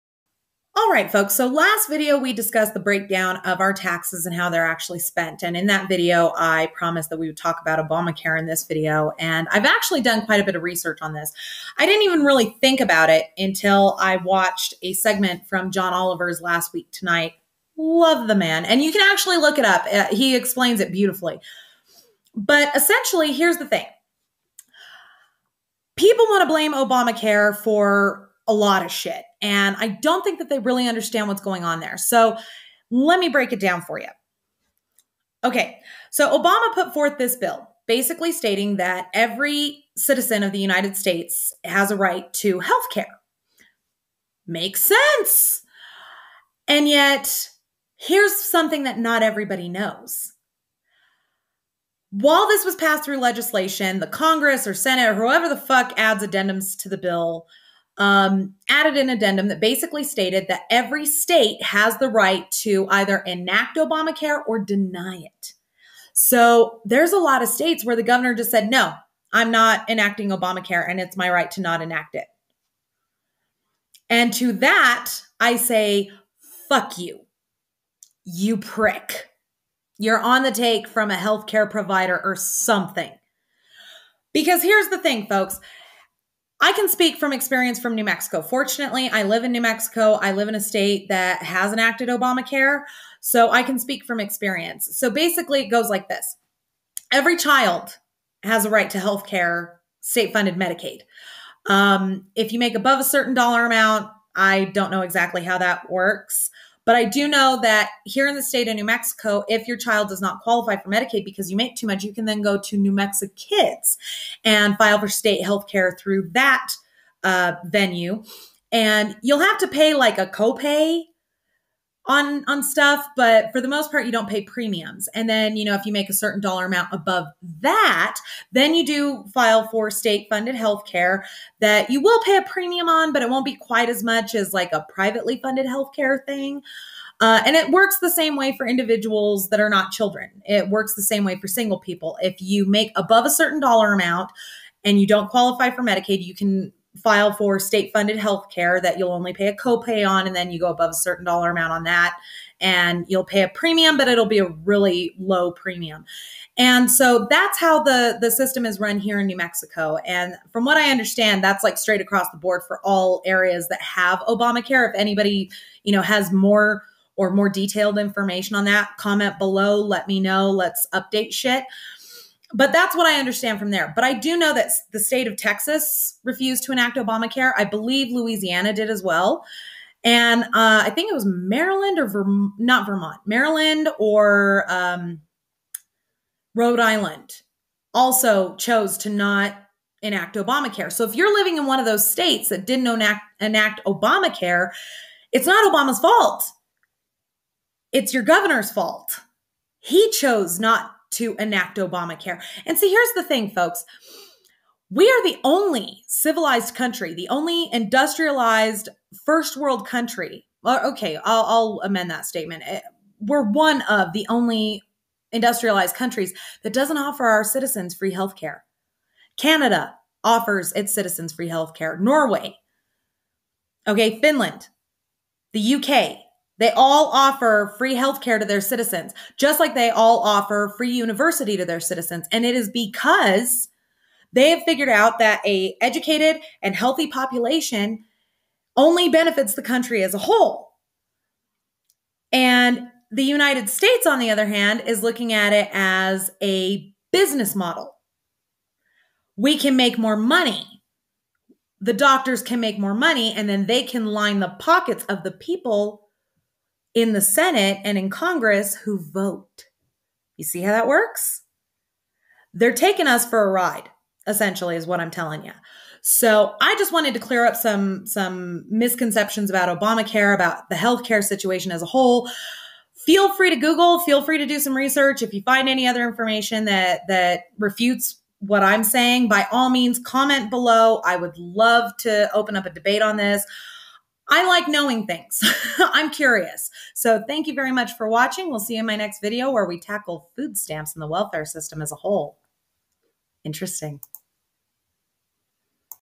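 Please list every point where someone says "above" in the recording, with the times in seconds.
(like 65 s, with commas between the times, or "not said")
102 s, 126 s, 142 s, 150 s.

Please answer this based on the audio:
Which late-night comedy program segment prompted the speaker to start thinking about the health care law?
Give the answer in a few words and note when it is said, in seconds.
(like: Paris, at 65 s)
Last Week Tonight, at 16 s.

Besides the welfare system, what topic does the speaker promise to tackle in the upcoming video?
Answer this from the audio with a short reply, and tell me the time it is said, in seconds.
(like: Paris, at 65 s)
food stamps, at 290 s.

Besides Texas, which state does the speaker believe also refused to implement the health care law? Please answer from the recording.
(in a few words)
Louisiana.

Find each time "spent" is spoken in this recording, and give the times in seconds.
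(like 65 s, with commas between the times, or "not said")
4 s.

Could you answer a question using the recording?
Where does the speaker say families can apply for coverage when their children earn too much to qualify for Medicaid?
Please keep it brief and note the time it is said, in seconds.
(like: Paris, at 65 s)
New Mexico Kids, at 112 s.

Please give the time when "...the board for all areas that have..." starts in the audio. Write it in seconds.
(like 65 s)
162 s.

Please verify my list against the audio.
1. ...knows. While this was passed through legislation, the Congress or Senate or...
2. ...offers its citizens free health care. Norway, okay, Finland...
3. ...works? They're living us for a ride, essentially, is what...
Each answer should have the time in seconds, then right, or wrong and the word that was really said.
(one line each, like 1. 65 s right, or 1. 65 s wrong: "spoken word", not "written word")
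1. 49 s right
2. 220 s right
3. 260 s wrong: "taking", not "living".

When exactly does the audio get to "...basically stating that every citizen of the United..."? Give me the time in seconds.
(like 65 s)
37 s.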